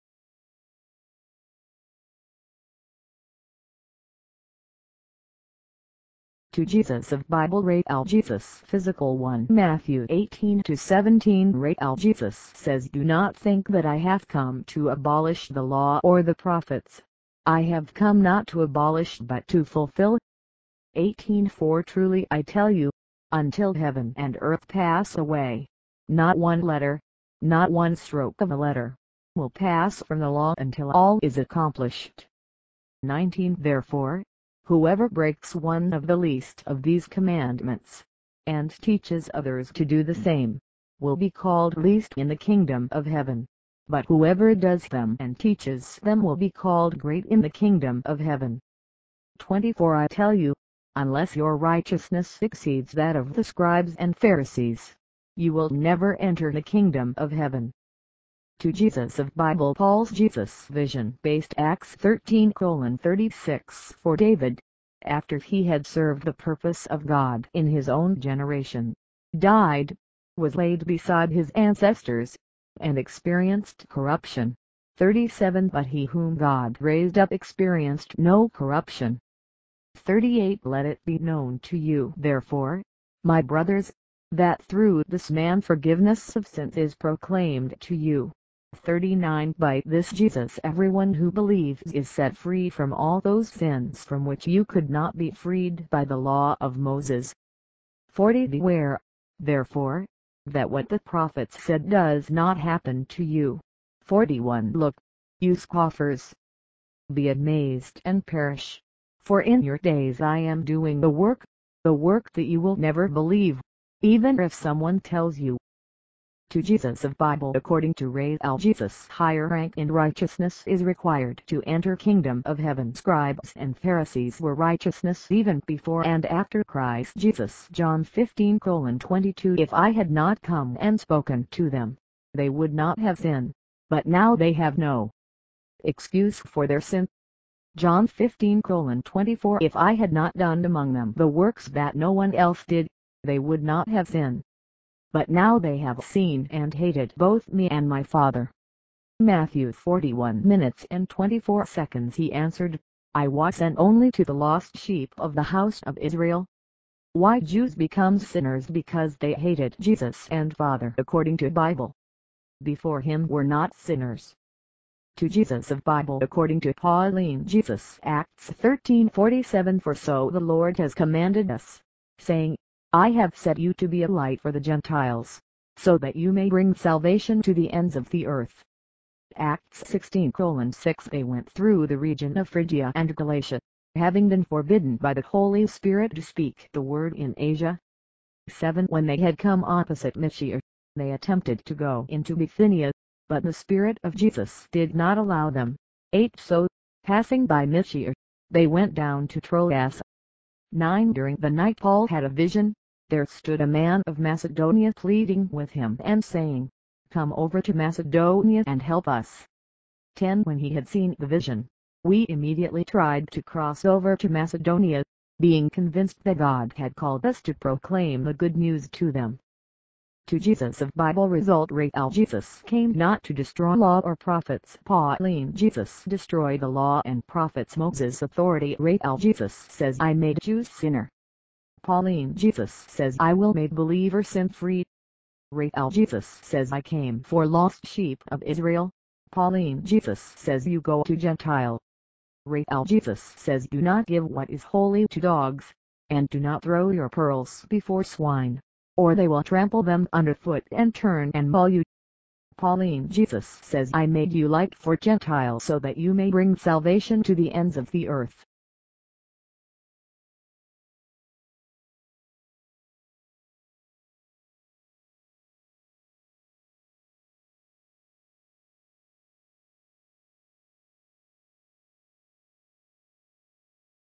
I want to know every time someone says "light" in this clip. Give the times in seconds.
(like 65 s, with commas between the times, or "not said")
174 s, 254 s.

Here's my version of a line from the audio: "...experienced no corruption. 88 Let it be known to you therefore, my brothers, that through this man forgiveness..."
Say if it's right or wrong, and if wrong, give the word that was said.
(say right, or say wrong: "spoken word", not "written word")
wrong: "38", not "88".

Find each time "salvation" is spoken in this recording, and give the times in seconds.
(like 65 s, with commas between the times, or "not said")
176 s, 256 s.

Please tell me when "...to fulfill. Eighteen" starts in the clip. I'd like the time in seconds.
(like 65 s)
19 s.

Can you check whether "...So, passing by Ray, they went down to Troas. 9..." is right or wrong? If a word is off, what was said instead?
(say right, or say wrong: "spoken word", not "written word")
wrong: "Mysia", not "Ray".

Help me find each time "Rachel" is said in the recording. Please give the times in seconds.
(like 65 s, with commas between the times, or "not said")
235 s, 242 s.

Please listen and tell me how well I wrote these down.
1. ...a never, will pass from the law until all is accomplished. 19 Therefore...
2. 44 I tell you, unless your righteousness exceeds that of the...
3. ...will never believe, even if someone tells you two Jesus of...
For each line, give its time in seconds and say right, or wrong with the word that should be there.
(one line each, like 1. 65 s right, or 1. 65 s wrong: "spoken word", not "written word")
1. 28 s wrong: "letter", not "never"
2. 49 s wrong: "24", not "44"
3. 112 s right.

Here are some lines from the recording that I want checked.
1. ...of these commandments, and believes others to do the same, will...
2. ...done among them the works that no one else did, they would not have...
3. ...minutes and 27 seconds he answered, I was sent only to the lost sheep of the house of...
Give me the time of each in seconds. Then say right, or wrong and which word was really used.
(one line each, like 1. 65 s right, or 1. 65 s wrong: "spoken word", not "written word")
1. 36 s wrong: "teaches", not "believes"
2. 140 s right
3. 150 s wrong: "24", not "27".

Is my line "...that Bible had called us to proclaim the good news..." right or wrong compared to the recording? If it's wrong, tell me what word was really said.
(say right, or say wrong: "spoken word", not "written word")
wrong: "God", not "Bible".